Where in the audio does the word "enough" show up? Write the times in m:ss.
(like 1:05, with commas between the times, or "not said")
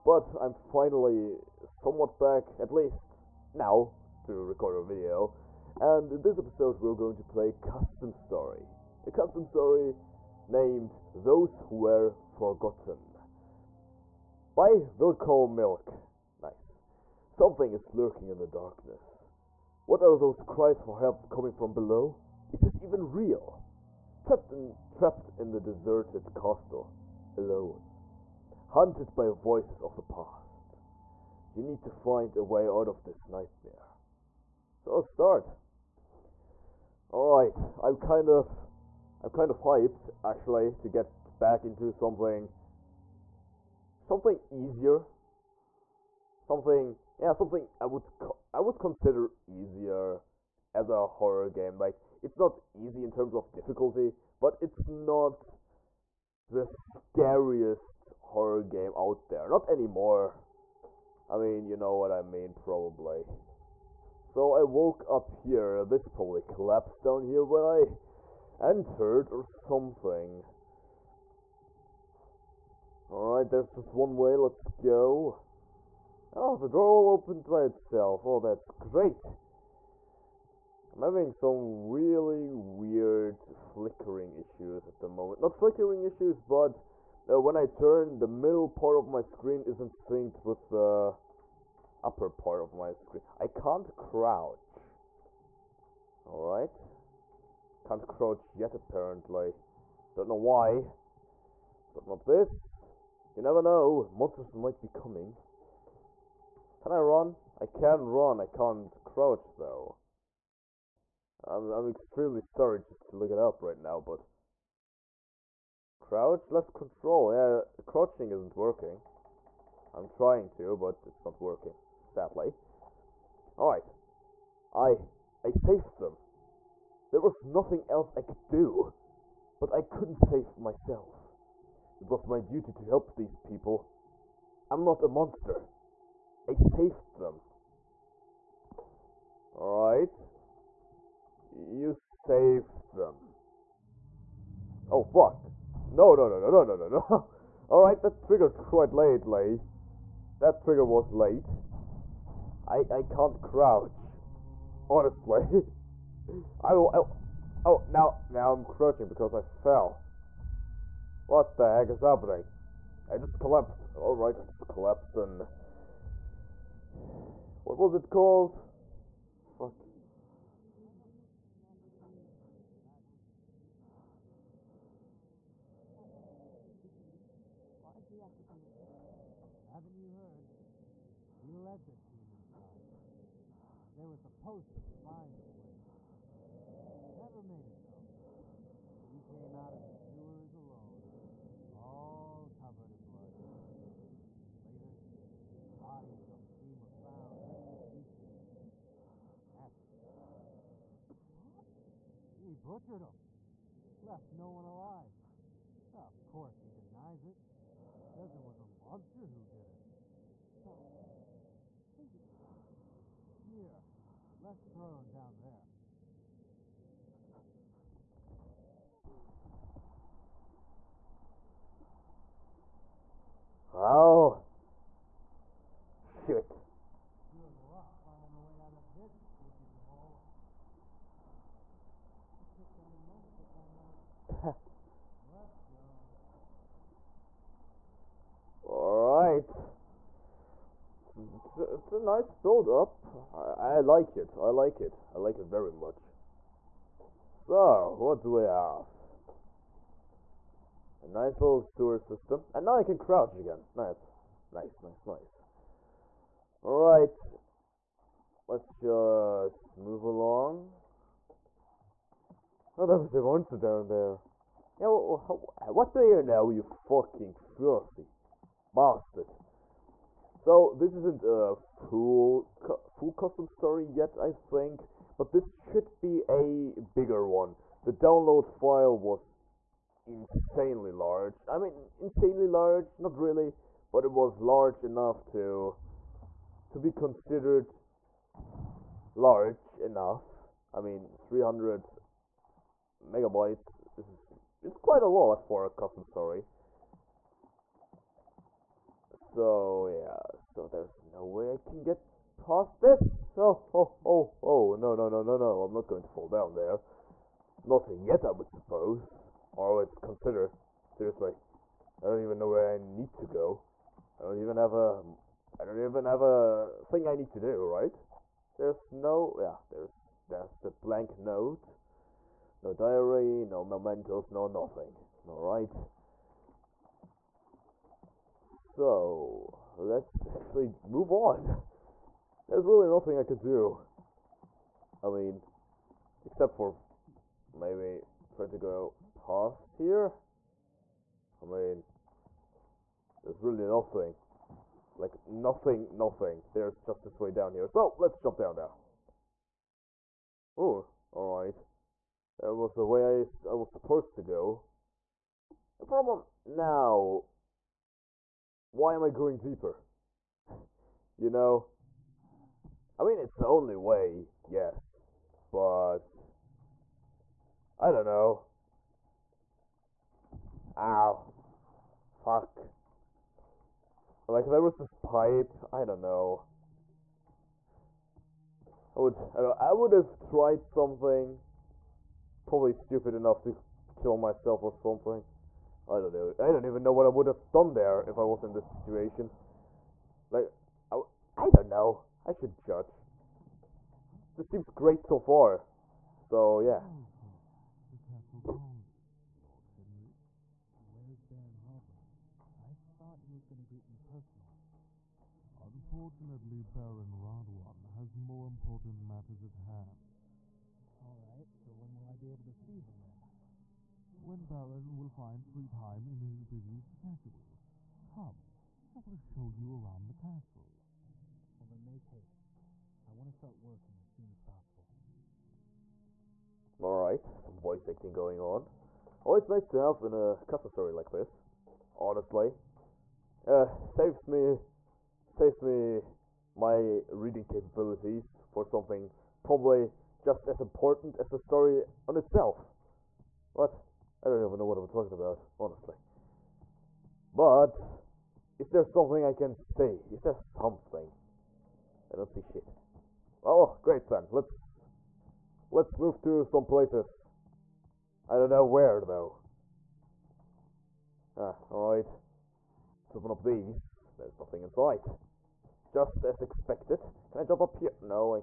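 4:44, 4:49, 6:23.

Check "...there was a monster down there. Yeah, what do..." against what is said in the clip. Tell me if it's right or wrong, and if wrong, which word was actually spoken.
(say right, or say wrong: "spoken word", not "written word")
right.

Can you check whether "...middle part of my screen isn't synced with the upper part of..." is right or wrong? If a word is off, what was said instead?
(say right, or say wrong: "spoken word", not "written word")
right.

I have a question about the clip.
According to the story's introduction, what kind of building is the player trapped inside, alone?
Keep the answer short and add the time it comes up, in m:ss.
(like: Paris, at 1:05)
deserted castle, at 0:25.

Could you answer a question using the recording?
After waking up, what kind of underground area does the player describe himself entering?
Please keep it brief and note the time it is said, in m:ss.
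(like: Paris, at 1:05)
sewer system, at 4:11.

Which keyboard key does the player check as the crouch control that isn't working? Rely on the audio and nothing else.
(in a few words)
left control.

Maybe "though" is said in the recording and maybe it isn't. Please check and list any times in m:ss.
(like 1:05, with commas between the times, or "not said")
1:49, 7:38.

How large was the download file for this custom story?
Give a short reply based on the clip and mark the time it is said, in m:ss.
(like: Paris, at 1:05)
300 megabytes, at 4:51.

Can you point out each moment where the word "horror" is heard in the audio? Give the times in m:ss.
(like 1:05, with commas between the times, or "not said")
0:51, 0:58.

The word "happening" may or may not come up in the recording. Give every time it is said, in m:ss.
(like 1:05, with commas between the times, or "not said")
2:41.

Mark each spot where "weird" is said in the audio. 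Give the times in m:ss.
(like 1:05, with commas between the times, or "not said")
1:22.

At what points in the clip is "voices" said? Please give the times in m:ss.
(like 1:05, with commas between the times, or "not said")
0:29, 7:07.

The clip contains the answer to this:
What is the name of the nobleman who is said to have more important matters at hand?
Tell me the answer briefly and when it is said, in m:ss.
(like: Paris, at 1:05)
Baron Radwan, at 6:46.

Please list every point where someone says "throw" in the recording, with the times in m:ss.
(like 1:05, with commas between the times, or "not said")
3:34.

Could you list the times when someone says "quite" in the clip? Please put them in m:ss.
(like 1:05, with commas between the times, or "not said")
2:28, 4:54.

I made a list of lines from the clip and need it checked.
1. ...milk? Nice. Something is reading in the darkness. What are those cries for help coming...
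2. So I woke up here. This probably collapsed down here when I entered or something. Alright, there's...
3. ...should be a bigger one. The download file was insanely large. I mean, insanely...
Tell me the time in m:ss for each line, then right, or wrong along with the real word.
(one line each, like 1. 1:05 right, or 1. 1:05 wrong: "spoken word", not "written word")
1. 0:15 wrong: "lurking", not "reading"
2. 1:04 right
3. 4:35 right.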